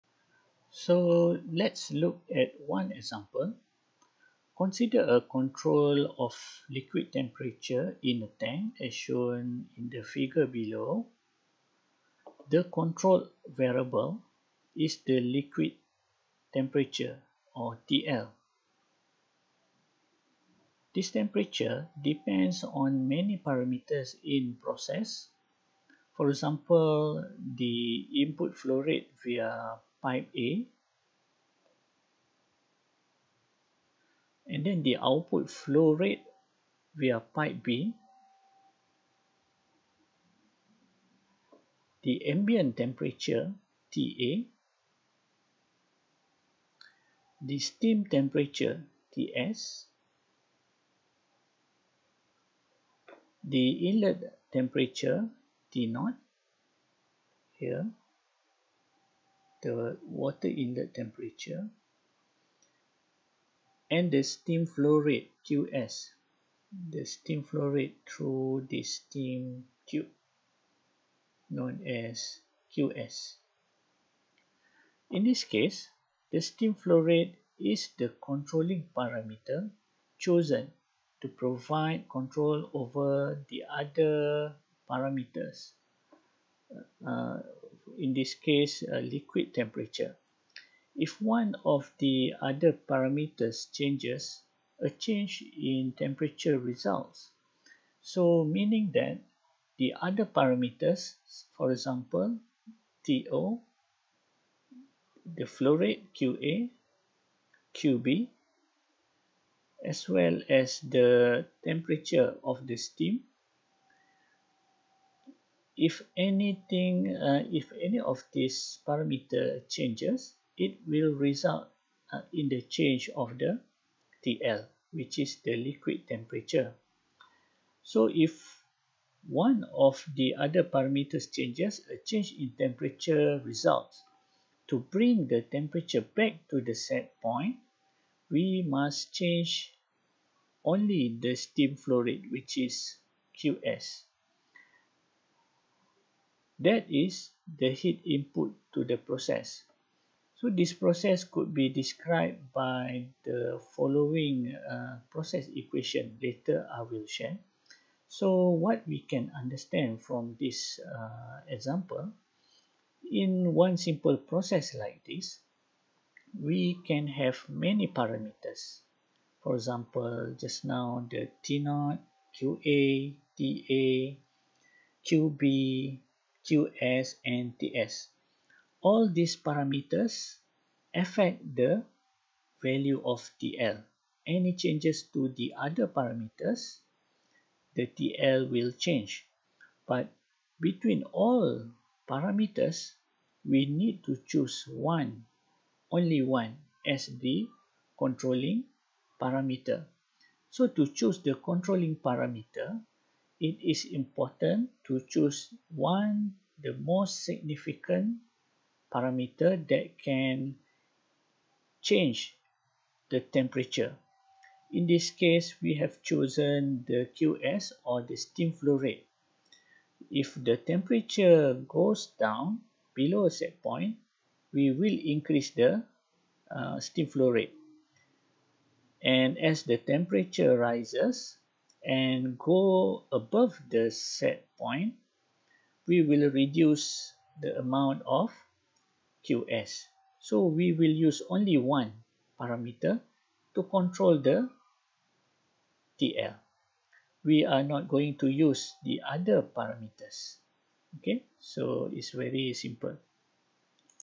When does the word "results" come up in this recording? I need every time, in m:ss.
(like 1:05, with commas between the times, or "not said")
1:36, 2:01, 2:13.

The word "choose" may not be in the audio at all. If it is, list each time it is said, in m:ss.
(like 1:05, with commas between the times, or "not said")
3:14, 3:20, 3:25.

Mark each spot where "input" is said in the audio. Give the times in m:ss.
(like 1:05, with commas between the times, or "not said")
0:28, 2:28.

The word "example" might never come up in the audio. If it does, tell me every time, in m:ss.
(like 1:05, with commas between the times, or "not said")
0:02, 0:26, 1:41, 2:41, 2:49.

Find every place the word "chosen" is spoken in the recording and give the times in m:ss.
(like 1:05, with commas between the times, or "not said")
1:20, 3:36.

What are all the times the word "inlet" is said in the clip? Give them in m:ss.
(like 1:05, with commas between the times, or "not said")
0:53, 1:00.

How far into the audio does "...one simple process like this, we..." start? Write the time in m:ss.
2:43.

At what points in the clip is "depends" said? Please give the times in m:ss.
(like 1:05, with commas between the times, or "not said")
0:22.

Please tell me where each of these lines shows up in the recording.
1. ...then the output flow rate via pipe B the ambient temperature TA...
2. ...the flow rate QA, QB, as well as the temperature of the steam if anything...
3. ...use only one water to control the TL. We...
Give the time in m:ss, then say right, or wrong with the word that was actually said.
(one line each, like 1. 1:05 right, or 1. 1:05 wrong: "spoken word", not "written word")
1. 0:34 right
2. 1:45 right
3. 4:00 wrong: "parameter", not "water".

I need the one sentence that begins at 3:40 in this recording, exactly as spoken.
If the temperature goes down below a set point, we will increase the uh, steam flow rate.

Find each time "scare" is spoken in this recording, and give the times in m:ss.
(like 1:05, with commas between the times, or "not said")
not said.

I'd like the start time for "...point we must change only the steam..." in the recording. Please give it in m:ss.
2:17.